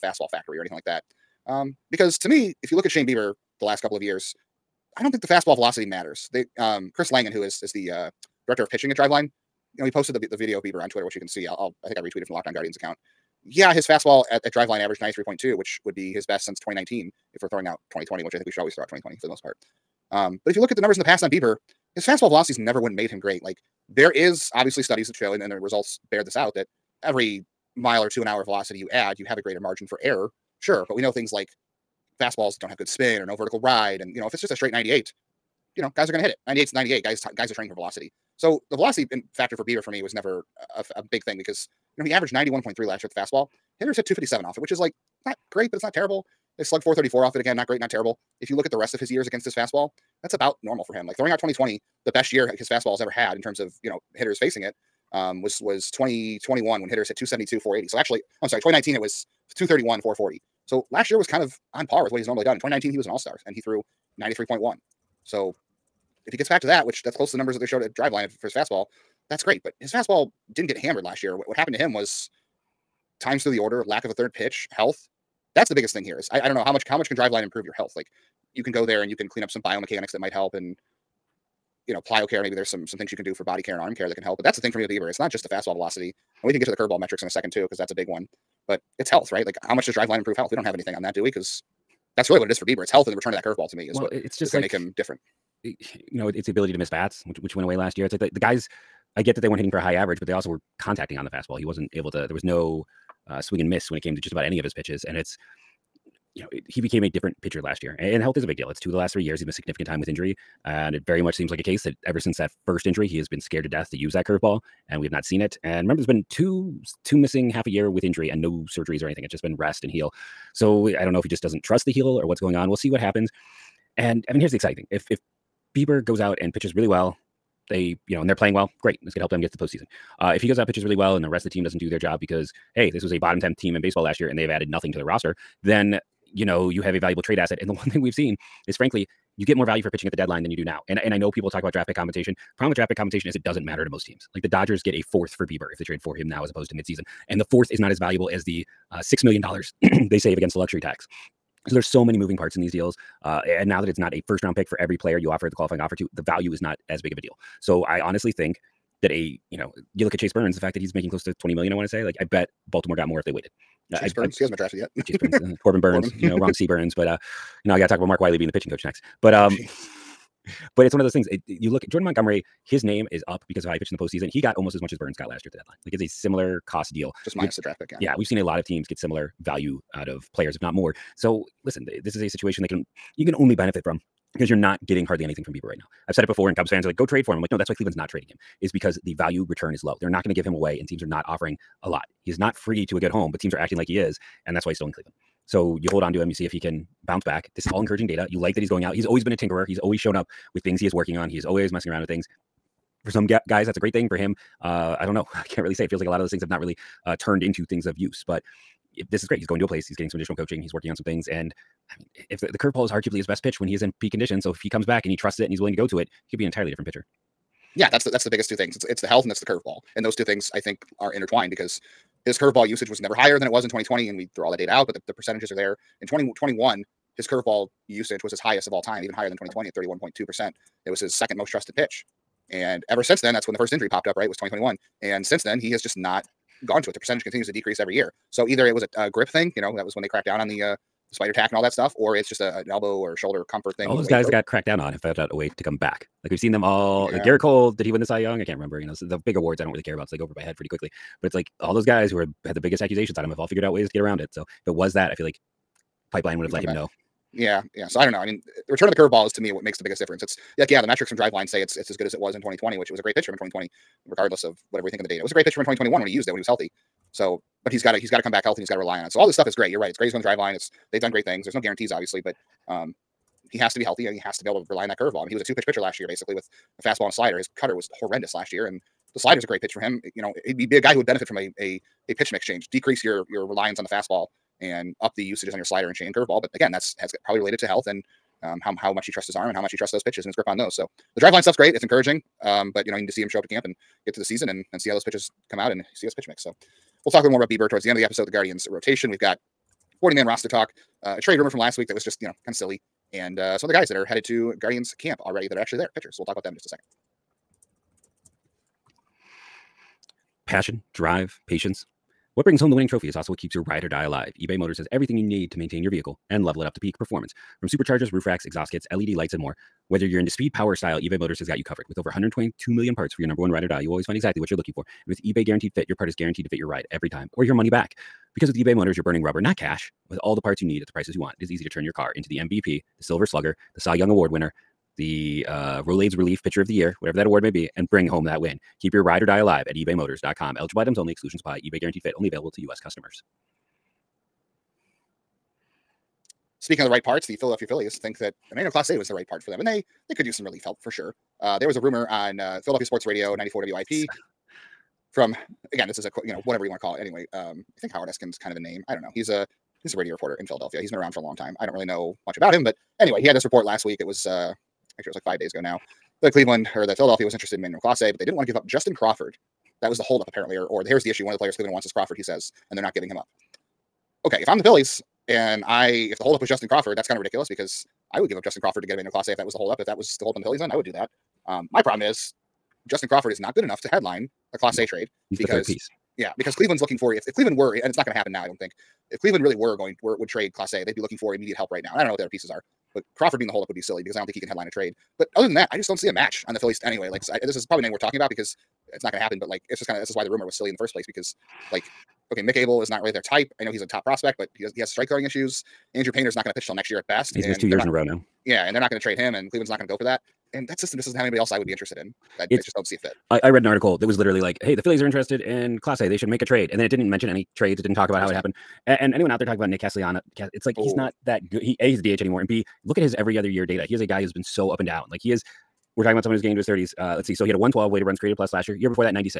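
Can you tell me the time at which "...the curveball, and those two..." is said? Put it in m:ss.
3:39.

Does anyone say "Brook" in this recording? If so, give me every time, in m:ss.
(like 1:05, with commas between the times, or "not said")
not said.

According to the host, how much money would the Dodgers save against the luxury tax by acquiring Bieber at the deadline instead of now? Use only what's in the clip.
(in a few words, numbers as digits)
6 million dollars.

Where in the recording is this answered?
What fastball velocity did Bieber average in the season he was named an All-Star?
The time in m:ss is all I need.
1:04.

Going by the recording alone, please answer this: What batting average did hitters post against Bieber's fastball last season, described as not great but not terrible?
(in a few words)
257.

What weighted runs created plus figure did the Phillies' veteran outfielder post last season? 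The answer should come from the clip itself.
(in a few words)
112.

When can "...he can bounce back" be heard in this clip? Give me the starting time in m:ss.
3:16.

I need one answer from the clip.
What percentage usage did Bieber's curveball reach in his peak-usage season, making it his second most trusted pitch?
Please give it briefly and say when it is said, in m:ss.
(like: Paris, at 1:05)
31.2%, at 3:49.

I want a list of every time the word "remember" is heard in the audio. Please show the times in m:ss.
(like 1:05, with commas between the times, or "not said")
1:55, 4:08.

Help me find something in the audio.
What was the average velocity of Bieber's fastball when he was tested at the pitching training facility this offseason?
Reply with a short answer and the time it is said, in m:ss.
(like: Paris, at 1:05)
93.2, at 0:14.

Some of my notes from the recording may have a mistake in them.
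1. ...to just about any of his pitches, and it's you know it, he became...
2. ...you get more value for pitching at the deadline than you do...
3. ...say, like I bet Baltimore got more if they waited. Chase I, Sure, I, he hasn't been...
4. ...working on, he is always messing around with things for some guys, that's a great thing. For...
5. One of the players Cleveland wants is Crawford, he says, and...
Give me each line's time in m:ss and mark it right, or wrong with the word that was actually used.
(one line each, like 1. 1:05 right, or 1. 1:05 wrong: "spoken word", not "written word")
1. 1:44 right
2. 2:19 right
3. 2:41 wrong: "Burns", not "Sure"
4. 3:20 right
5. 6:11 right.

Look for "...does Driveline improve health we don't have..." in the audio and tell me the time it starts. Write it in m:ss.
1:29.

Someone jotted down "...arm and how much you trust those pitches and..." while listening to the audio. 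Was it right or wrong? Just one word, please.
right.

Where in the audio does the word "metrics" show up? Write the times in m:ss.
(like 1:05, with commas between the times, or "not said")
1:26, 4:20.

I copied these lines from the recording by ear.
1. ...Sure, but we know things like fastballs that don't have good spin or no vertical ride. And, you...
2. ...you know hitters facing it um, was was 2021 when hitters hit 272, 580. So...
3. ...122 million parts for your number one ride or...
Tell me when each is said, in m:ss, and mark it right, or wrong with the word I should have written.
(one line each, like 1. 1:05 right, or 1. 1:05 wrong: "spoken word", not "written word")
1. 0:30 right
2. 0:53 wrong: "480", not "580"
3. 5:22 right.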